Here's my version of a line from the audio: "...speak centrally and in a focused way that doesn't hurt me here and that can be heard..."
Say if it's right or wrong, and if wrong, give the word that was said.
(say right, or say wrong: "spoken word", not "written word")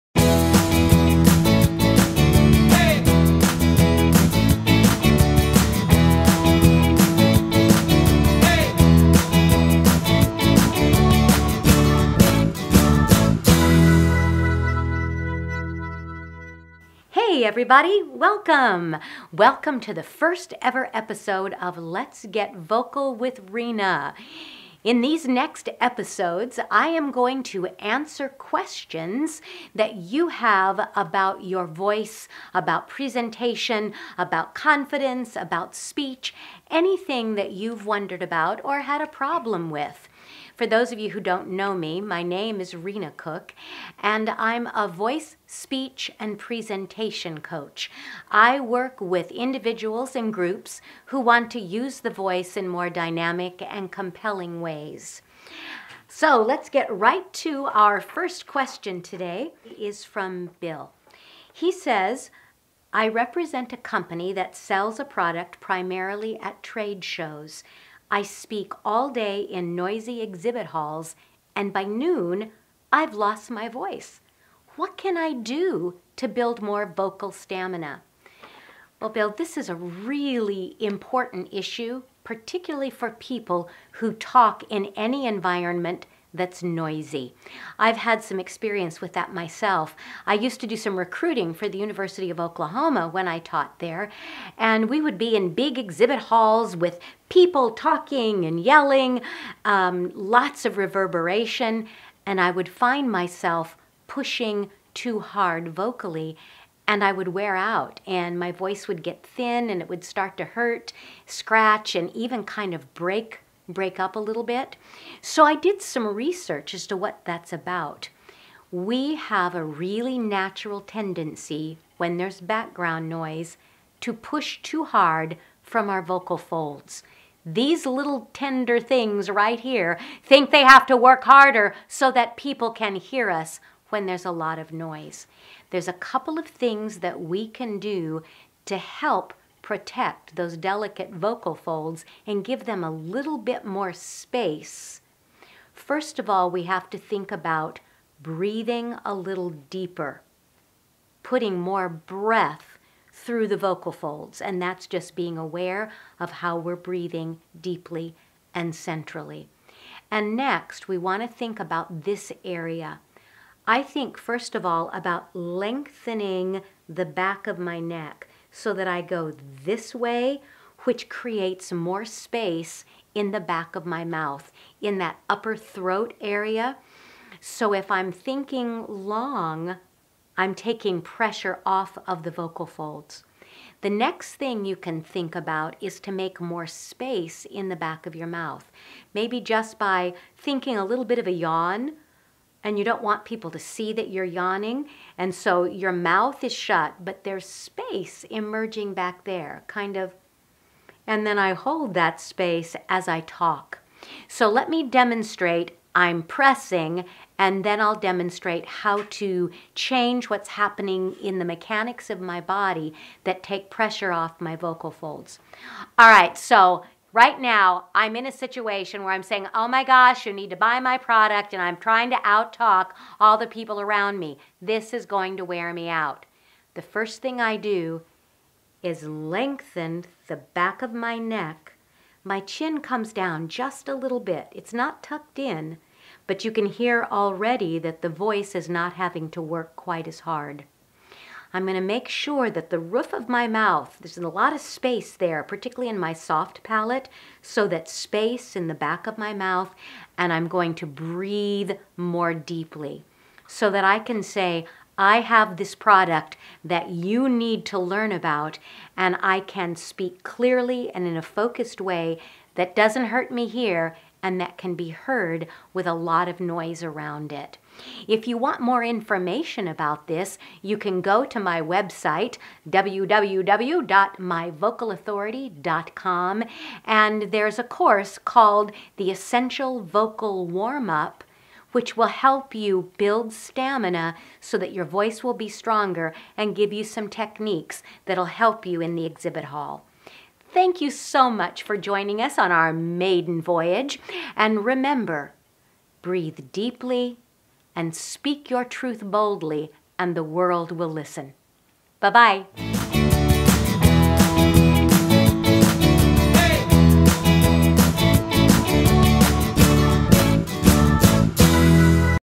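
wrong: "clearly", not "centrally".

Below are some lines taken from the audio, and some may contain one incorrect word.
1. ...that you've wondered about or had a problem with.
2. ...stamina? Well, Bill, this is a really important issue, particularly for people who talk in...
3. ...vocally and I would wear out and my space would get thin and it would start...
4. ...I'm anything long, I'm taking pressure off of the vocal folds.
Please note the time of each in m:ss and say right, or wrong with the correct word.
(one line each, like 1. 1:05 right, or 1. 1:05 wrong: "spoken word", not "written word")
1. 0:37 right
2. 1:17 right
3. 1:45 wrong: "voice", not "space"
4. 2:57 wrong: "thinking", not "anything".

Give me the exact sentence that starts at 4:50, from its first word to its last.
Thank you so much for joining us on our maiden voyage.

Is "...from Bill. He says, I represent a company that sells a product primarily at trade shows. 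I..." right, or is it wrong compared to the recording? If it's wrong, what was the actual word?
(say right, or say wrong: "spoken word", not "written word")
right.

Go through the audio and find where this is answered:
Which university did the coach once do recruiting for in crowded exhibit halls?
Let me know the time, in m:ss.
1:31.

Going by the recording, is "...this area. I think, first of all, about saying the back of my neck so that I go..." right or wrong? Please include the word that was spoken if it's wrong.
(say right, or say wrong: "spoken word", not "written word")
wrong: "lengthening", not "saying".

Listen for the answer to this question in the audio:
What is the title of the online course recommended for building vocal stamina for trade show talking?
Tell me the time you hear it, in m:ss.
4:38.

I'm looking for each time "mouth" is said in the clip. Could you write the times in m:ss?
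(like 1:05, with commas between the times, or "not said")
2:54, 3:08, 3:15, 4:03, 4:09.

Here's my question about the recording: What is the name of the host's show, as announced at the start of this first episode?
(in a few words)
Let's Get Vocal with Rena.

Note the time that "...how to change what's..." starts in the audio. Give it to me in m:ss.
3:28.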